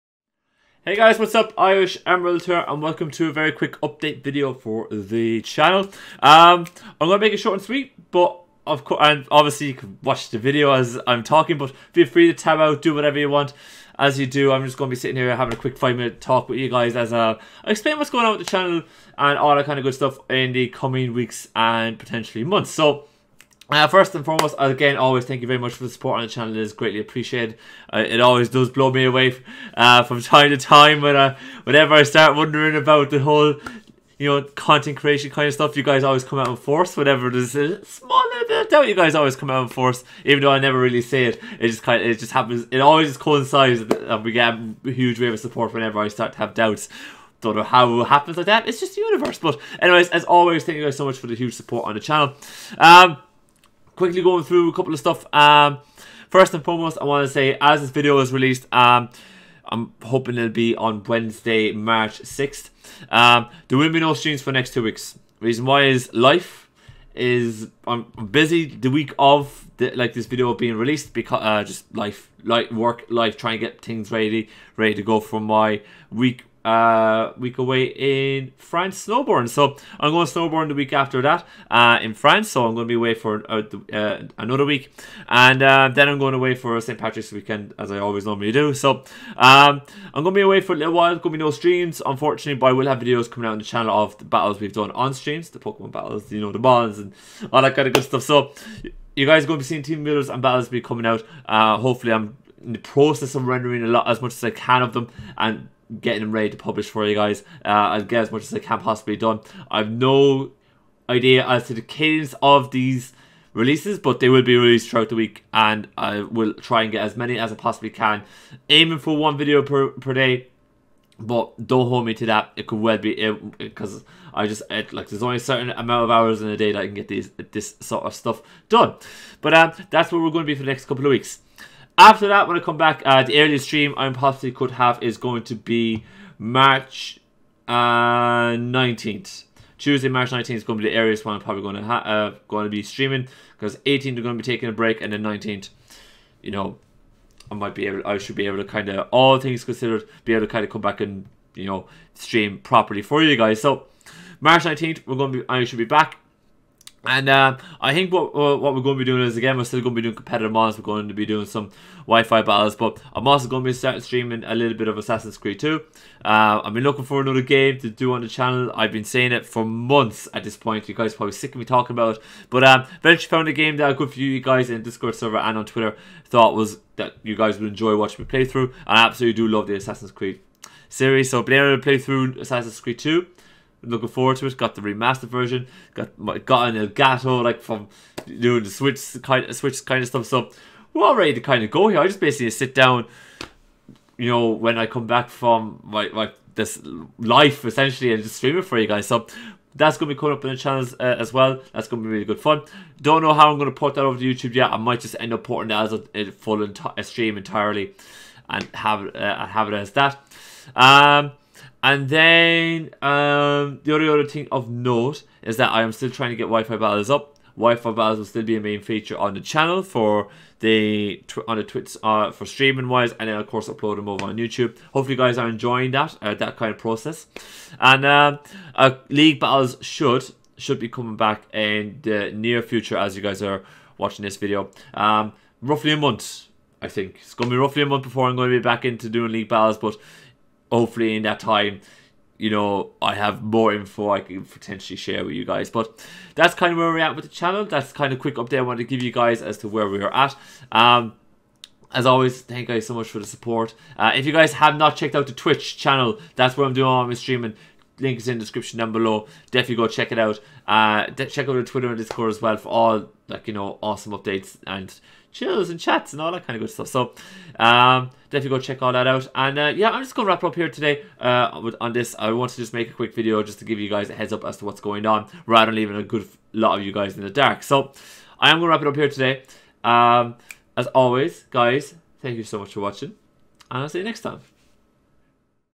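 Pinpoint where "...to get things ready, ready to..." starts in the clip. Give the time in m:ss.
1:13.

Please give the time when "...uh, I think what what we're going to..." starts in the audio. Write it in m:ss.
2:37.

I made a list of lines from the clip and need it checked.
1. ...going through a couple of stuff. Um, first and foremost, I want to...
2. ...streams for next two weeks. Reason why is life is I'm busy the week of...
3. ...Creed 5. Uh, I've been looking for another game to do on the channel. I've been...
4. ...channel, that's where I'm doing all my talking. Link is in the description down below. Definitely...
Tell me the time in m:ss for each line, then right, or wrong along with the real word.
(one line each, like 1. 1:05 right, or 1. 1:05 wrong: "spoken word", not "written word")
1. 0:54 right
2. 1:04 right
3. 2:45 wrong: "2", not "5"
4. 4:15 wrong: "streaming", not "talking".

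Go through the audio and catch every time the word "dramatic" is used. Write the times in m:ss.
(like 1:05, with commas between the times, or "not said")
not said.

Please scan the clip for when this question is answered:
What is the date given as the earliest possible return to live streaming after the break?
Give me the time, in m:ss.
2:19.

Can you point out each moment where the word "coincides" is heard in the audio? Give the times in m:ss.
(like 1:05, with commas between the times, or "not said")
0:43.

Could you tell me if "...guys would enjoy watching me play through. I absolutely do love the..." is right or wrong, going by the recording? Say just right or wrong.
right.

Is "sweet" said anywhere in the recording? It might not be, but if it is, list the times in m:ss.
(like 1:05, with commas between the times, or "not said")
0:07.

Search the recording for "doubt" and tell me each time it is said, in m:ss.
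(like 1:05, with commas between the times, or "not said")
0:38, 0:46.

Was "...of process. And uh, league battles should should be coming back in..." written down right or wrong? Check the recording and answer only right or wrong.
right.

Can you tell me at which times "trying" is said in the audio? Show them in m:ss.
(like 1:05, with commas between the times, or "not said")
1:13, 3:36.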